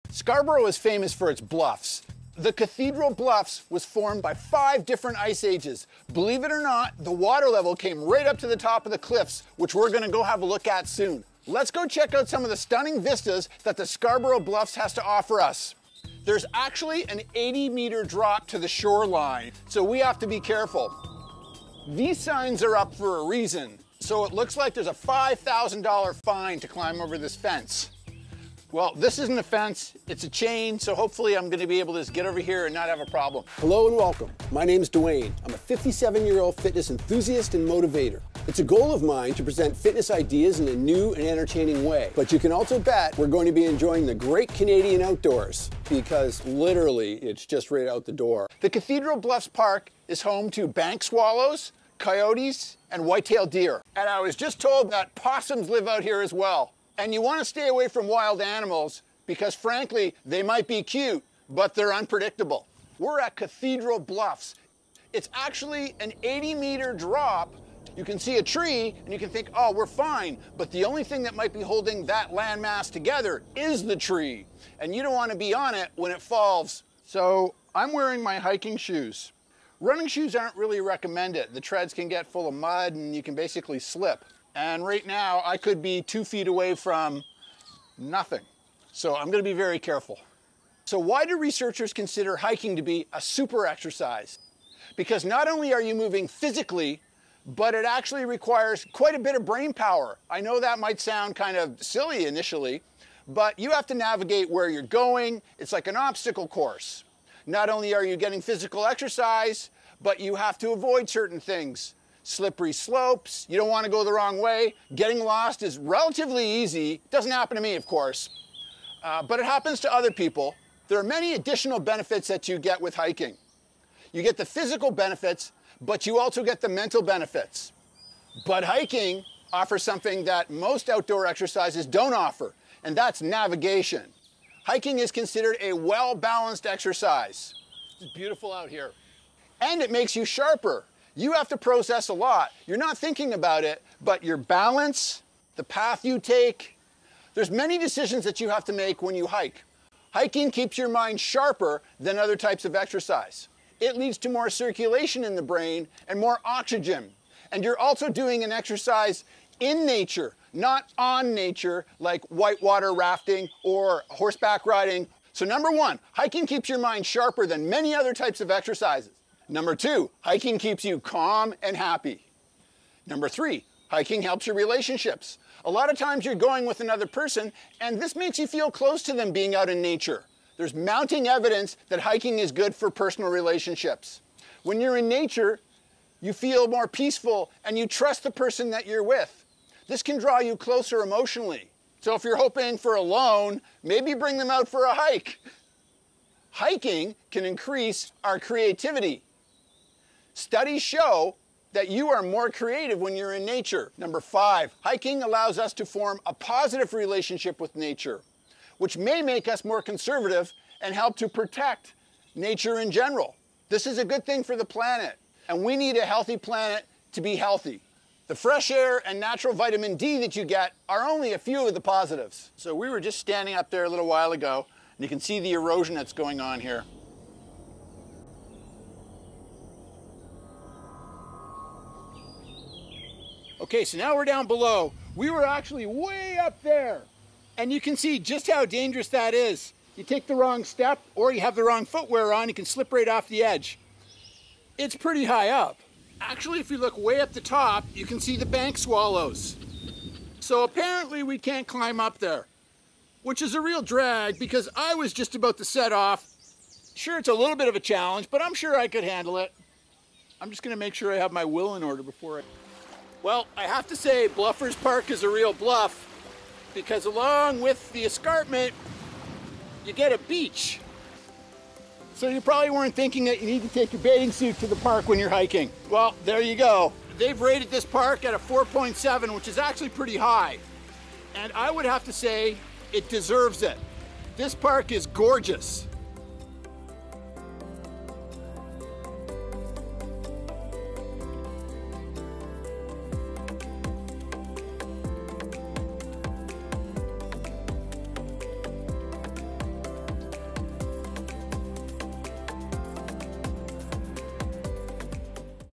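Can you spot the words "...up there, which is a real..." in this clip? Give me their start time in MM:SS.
04:11.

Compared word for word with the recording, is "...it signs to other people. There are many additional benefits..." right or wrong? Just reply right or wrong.
wrong.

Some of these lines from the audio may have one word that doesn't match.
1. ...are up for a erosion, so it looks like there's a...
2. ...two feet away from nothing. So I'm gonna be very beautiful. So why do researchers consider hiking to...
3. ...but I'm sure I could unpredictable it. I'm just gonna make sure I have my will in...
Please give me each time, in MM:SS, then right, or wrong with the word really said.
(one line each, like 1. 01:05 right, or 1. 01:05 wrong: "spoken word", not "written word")
1. 00:22 wrong: "reason", not "erosion"
2. 01:26 wrong: "careful", not "beautiful"
3. 04:18 wrong: "handle", not "unpredictable".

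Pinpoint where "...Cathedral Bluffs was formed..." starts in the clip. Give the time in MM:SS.
00:02.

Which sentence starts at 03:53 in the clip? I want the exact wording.
Okay, so now we're down below.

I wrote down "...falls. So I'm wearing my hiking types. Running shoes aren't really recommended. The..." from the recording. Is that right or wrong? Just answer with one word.
wrong.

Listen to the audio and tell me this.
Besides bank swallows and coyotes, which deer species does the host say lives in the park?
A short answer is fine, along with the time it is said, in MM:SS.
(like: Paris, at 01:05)
White-tailed deer, at 00:53.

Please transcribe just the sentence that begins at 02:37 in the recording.
And you're also doing an exercise in nature, not on nature, like whitewater rafting or horseback riding.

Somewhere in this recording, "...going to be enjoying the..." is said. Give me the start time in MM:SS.
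00:43.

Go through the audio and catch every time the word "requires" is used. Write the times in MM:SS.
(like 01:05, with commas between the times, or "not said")
01:38.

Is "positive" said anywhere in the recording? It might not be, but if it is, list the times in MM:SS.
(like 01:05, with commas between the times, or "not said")
03:26, 03:41.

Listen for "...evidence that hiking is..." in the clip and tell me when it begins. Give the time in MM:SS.
03:01.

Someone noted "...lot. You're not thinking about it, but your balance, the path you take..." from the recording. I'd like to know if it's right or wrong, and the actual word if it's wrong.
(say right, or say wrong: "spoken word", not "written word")
right.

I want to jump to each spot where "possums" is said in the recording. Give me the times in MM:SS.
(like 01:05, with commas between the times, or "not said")
00:55.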